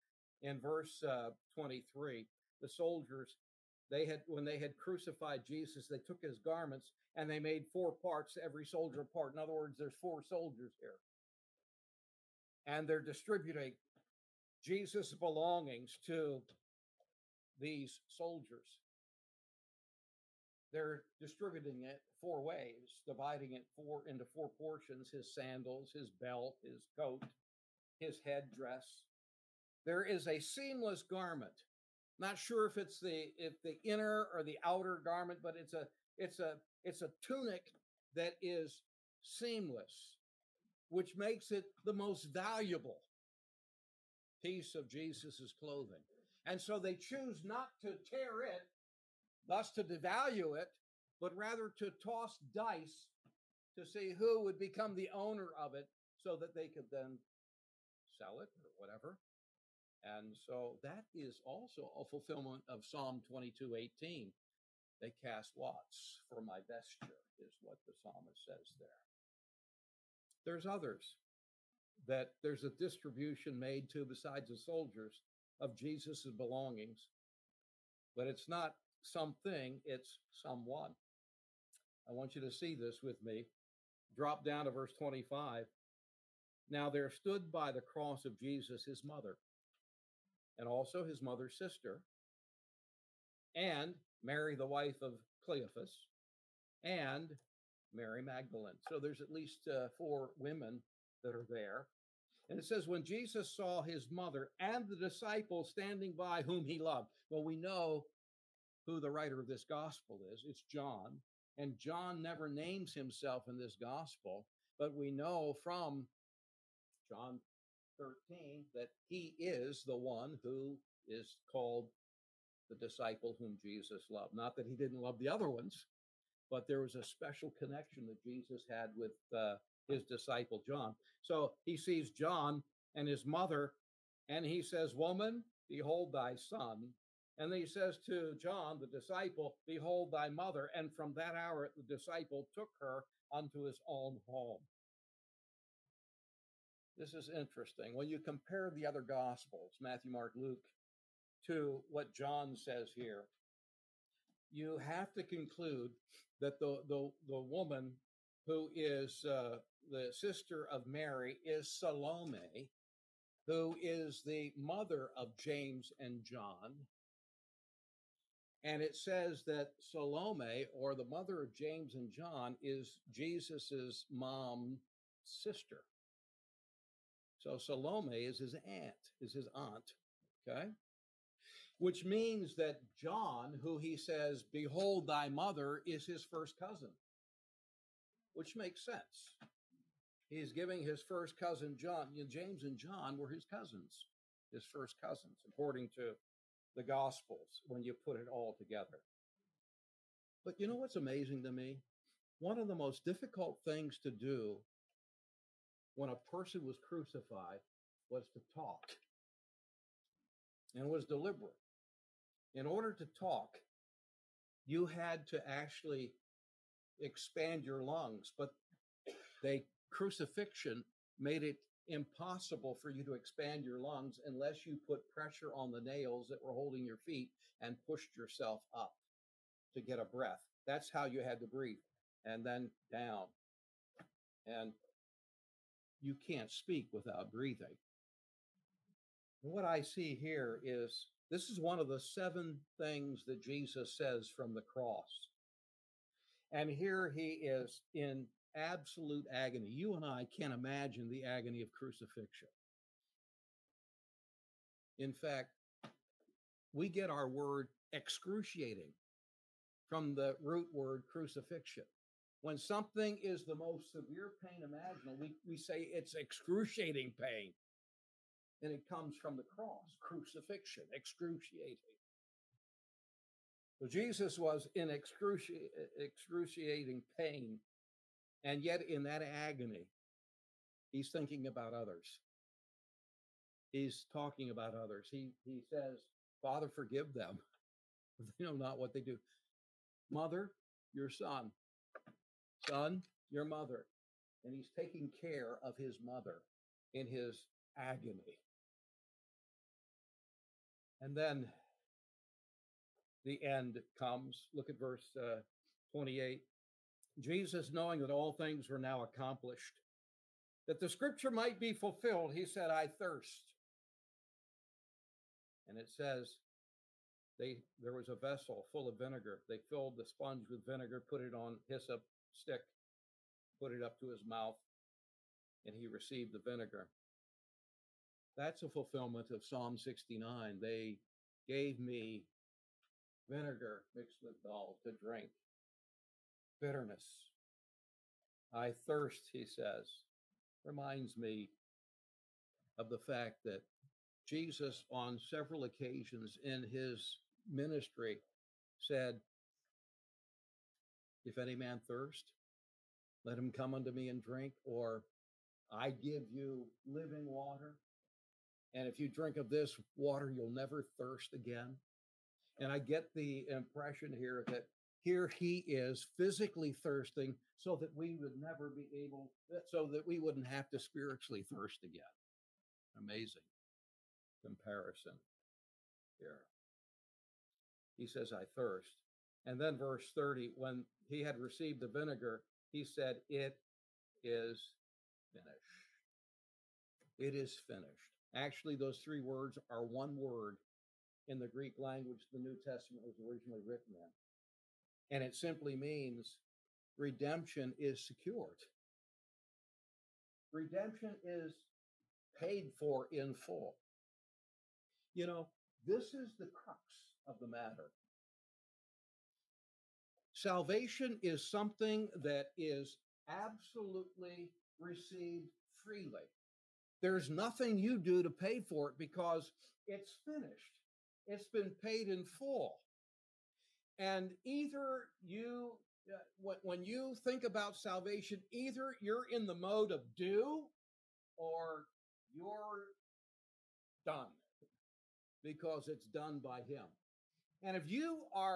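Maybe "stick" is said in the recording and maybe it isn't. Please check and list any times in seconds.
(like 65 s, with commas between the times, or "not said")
322 s.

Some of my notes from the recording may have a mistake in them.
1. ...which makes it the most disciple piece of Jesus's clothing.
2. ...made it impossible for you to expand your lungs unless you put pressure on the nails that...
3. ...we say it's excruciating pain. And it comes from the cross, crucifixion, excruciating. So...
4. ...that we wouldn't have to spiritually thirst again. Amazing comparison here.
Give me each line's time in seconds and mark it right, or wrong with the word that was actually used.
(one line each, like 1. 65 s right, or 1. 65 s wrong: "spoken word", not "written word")
1. 40 s wrong: "valuable", not "disciple"
2. 221 s right
3. 265 s right
4. 369 s right.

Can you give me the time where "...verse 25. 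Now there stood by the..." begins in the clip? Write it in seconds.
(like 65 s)
84 s.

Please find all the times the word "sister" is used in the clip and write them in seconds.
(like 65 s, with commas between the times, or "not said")
91 s, 160 s, 175 s.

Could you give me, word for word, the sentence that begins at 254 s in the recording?
In fact, we get our word excruciating from the root word crucifixion.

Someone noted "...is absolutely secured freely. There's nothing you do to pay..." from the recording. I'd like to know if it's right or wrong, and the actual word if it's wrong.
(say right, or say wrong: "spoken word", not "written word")
wrong: "received", not "secured".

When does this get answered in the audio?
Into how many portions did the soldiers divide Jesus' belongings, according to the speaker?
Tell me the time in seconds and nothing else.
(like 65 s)
24 s.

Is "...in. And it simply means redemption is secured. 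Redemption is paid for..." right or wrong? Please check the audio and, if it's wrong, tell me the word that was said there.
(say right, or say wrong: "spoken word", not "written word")
right.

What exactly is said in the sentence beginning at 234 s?
And you can't speak without breathing.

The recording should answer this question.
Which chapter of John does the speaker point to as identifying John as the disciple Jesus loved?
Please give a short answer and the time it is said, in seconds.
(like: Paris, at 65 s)
John 13, at 117 s.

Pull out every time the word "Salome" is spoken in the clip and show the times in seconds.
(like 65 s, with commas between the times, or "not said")
161 s, 169 s, 177 s.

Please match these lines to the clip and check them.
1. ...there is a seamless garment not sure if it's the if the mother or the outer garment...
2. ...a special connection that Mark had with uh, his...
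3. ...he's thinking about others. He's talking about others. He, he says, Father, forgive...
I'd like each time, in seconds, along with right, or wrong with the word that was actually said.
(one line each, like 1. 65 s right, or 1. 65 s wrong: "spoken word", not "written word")
1. 29 s wrong: "inner", not "mother"
2. 126 s wrong: "Jesus", not "Mark"
3. 280 s right.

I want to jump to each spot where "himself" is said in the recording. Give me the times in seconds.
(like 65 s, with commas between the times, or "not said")
112 s.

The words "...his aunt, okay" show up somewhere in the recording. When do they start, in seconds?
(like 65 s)
179 s.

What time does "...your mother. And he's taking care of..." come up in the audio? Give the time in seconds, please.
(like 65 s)
293 s.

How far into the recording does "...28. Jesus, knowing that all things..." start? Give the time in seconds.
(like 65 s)
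305 s.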